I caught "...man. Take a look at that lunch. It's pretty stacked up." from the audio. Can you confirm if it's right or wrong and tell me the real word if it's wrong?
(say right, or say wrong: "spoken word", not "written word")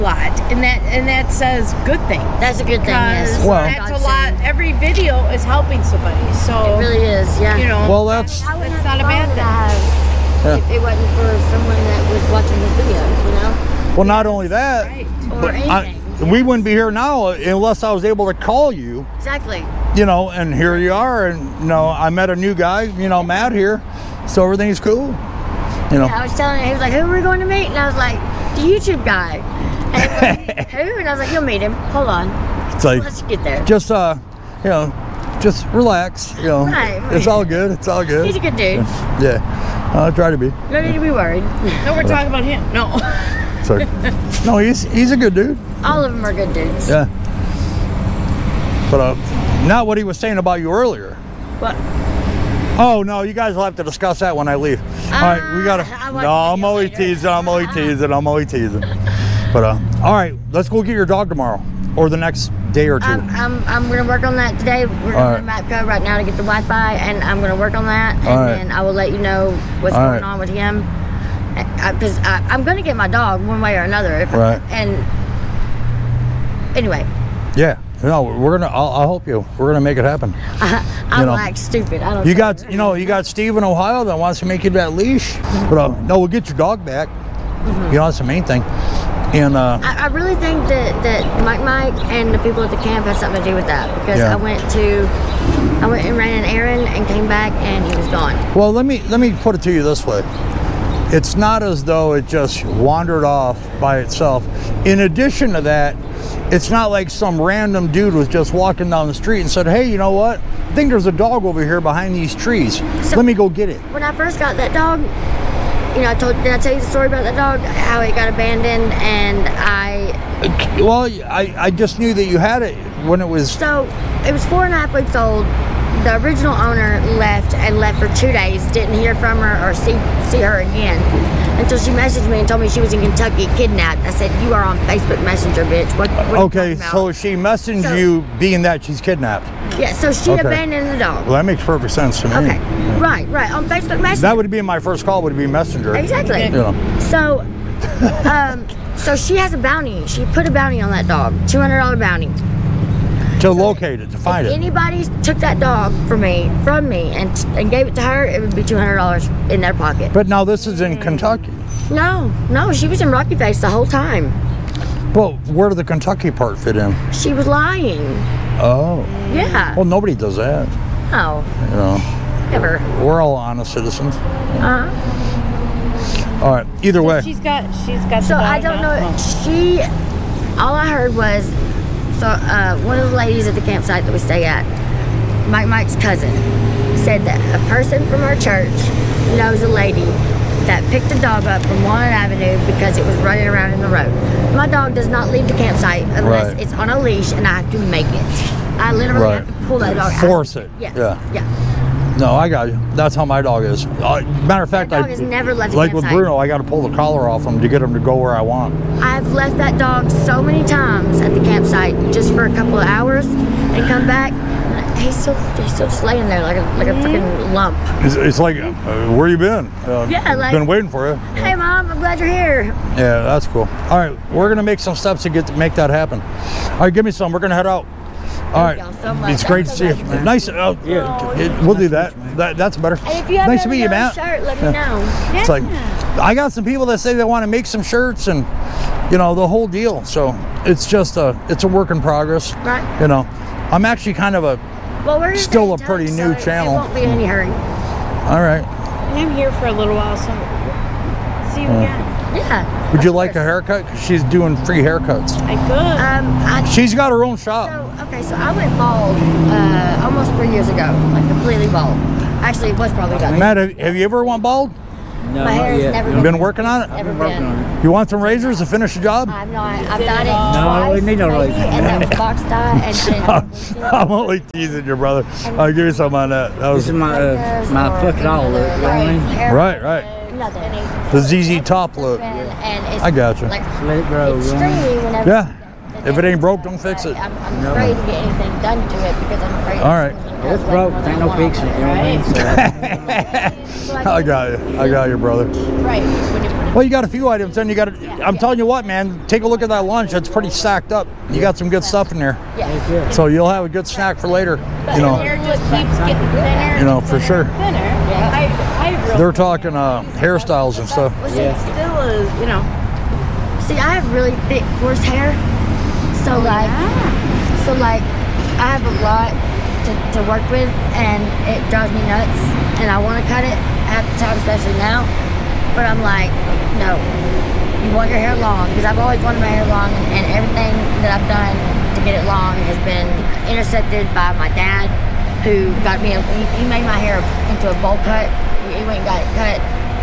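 right.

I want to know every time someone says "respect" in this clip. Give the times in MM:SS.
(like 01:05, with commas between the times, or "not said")
not said.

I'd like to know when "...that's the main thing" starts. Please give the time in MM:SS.
01:28.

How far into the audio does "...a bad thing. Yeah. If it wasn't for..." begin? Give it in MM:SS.
00:09.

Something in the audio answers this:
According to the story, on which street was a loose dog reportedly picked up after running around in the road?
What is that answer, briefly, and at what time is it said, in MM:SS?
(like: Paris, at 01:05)
Walnut Avenue, at 03:11.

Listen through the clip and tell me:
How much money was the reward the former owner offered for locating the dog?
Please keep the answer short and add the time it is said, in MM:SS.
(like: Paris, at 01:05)
$200, at 02:31.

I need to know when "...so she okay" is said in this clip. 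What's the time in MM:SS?
02:19.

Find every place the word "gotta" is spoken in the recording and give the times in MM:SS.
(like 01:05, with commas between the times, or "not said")
00:55.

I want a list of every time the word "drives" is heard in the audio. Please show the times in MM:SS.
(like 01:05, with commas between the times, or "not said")
05:21.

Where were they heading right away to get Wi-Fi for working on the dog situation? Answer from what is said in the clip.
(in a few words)
Mapco.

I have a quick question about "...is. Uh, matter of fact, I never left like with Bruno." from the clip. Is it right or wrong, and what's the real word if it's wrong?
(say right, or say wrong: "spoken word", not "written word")
right.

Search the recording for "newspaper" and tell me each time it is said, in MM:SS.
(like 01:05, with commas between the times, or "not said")
not said.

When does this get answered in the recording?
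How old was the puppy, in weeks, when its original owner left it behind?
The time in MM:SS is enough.
02:04.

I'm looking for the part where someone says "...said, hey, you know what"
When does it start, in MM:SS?
01:49.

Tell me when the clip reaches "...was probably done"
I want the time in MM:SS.
04:22.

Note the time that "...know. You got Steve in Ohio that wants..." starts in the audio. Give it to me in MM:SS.
01:22.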